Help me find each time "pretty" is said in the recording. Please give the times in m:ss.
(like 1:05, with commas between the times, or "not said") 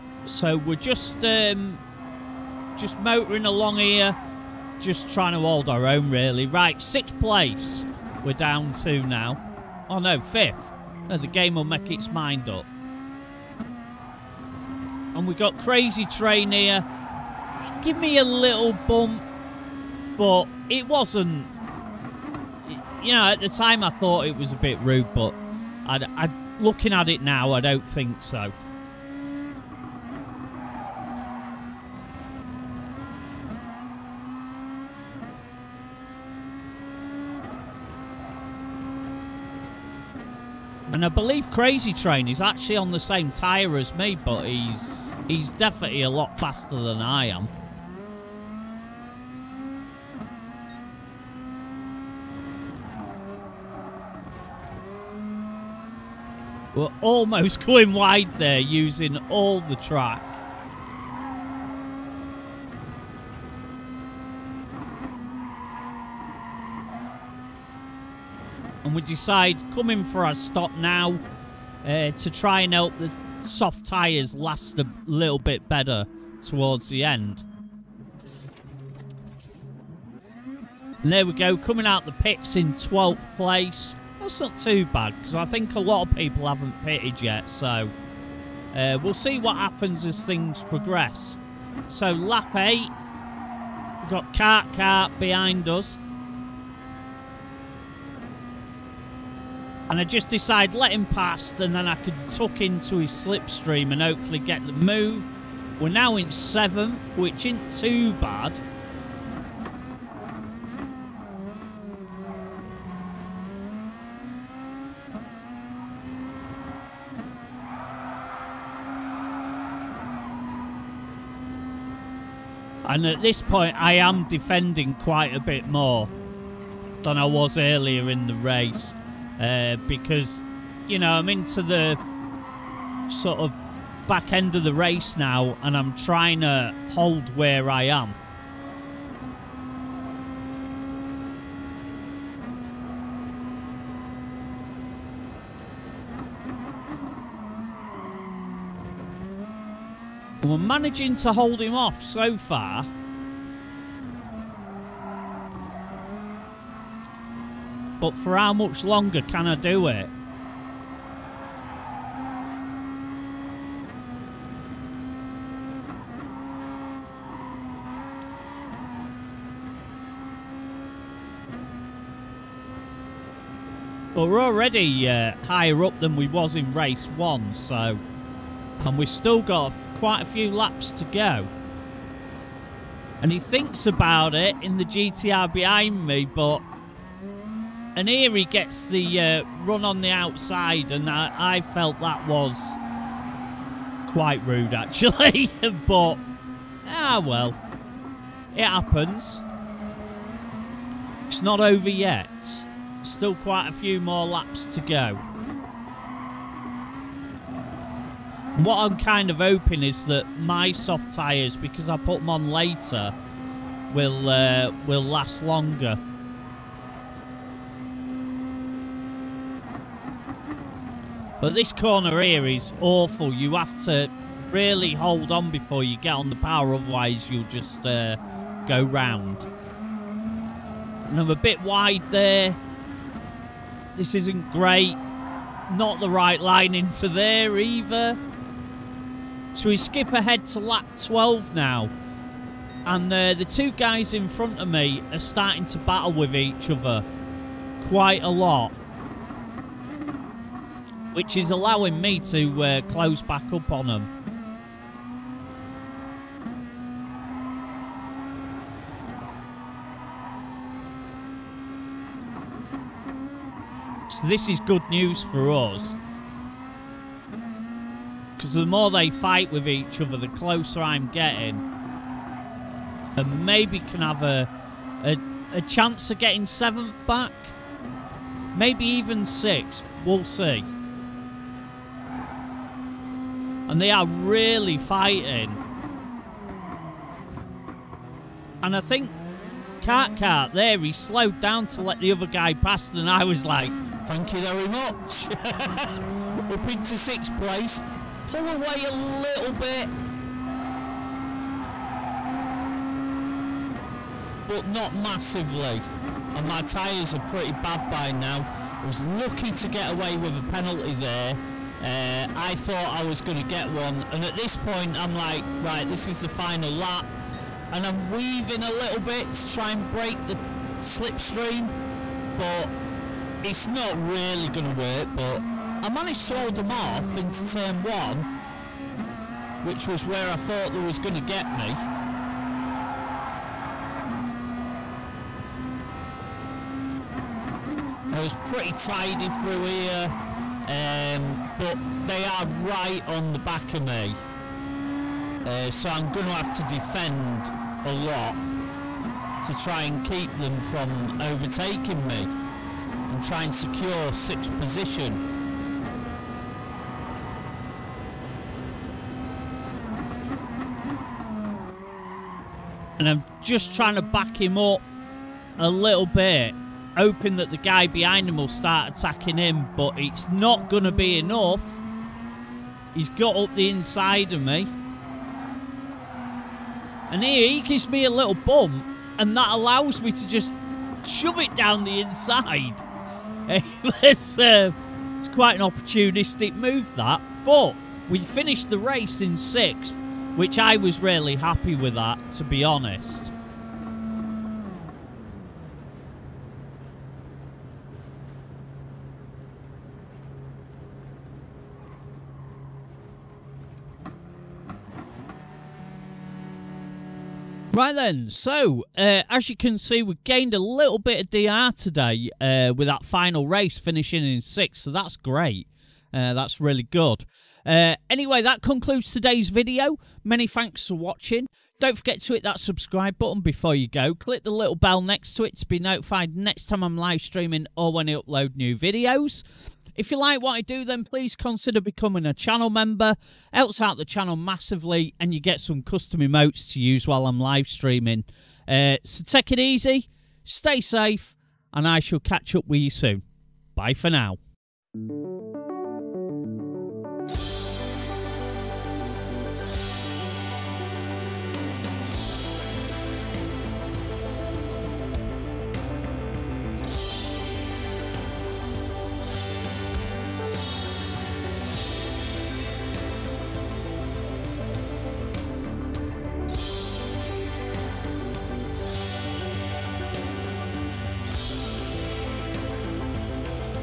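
5:07, 5:38.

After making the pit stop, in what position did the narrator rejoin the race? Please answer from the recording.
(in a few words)
12th.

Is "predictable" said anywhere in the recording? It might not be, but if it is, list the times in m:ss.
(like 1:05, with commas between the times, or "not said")
not said.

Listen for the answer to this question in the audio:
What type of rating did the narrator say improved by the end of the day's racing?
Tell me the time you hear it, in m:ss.
6:51.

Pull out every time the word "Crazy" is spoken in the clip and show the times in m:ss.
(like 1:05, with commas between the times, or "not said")
0:15, 0:41.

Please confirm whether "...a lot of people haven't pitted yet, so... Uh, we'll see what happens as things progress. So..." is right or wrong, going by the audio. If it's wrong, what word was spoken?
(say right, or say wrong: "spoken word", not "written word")
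right.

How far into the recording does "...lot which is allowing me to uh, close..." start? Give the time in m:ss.
4:08.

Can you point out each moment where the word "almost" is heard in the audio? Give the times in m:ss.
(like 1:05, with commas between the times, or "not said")
0:57.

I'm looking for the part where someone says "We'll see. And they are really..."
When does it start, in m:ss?
4:40.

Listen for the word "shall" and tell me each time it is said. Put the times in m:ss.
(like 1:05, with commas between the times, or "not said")
7:21.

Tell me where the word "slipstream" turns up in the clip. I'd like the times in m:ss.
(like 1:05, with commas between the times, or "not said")
1:43, 5:20.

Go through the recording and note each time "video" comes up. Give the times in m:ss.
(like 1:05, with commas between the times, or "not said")
6:59, 7:08.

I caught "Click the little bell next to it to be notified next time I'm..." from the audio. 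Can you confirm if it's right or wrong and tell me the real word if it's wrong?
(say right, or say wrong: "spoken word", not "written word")
right.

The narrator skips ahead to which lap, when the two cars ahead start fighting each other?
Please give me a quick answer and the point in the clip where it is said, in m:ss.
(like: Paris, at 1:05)
12, at 4:00.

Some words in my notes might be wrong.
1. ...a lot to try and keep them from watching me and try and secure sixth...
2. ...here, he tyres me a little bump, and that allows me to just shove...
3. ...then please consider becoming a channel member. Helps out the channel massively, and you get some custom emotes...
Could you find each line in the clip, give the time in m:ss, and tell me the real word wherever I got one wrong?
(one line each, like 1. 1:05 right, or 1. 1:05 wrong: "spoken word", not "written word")
1. 5:47 wrong: "overtaking", not "watching"
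2. 6:17 wrong: "gives", not "tyres"
3. 7:10 right.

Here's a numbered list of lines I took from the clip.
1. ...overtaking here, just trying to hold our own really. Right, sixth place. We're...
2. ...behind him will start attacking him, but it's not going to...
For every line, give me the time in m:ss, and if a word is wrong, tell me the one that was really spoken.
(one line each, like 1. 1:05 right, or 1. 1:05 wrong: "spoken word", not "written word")
1. 0:03 wrong: "along", not "overtaking"
2. 6:07 right.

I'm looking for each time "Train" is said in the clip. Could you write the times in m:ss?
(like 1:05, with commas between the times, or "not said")
0:16, 0:41.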